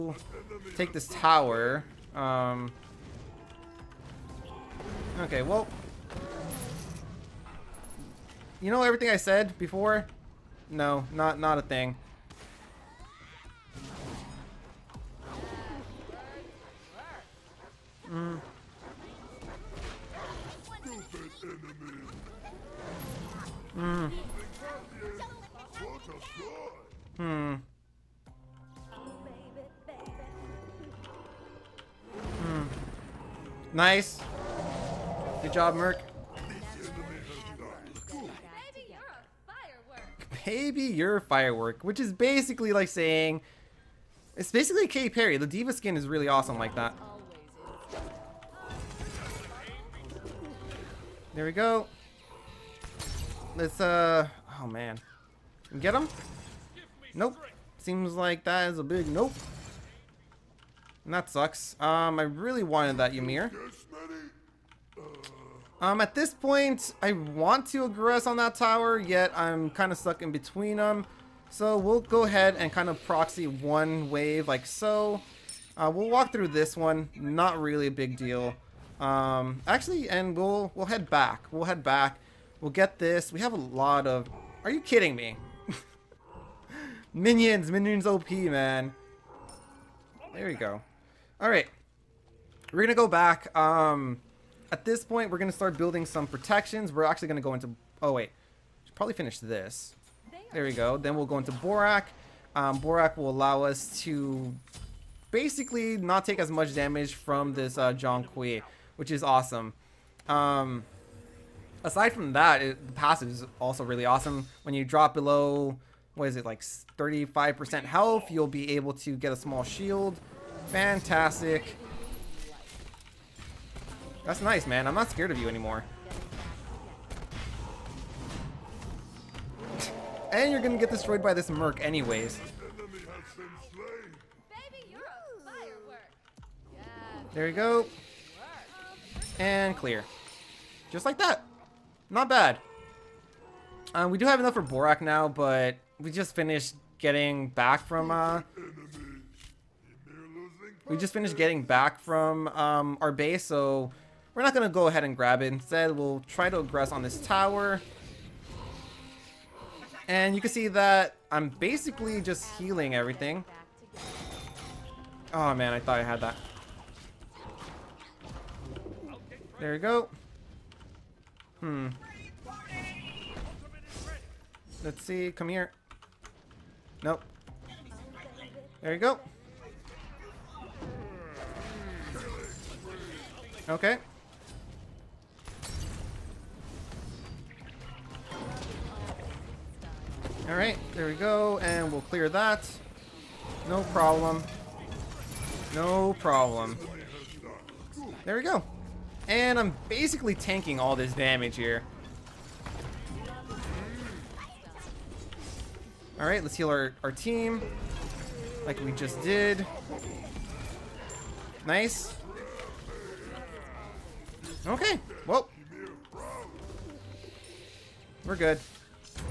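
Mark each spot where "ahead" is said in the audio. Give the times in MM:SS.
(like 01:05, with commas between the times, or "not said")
01:12, 02:34.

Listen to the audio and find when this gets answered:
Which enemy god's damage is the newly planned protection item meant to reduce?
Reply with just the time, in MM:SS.
01:47.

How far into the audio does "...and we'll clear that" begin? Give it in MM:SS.
03:11.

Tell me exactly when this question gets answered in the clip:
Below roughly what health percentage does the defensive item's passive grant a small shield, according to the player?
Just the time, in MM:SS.
01:56.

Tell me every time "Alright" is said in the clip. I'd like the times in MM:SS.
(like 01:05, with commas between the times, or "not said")
03:10, 03:26.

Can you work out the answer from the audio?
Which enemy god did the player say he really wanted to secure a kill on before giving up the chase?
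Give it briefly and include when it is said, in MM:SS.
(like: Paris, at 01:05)
Ymir, at 01:03.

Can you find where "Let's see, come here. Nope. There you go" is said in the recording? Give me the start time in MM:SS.
02:54.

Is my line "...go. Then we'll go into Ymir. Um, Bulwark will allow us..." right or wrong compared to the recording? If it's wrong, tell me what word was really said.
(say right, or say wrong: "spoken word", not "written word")
wrong: "Bulwark", not "Ymir".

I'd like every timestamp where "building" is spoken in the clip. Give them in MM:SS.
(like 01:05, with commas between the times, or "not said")
01:35.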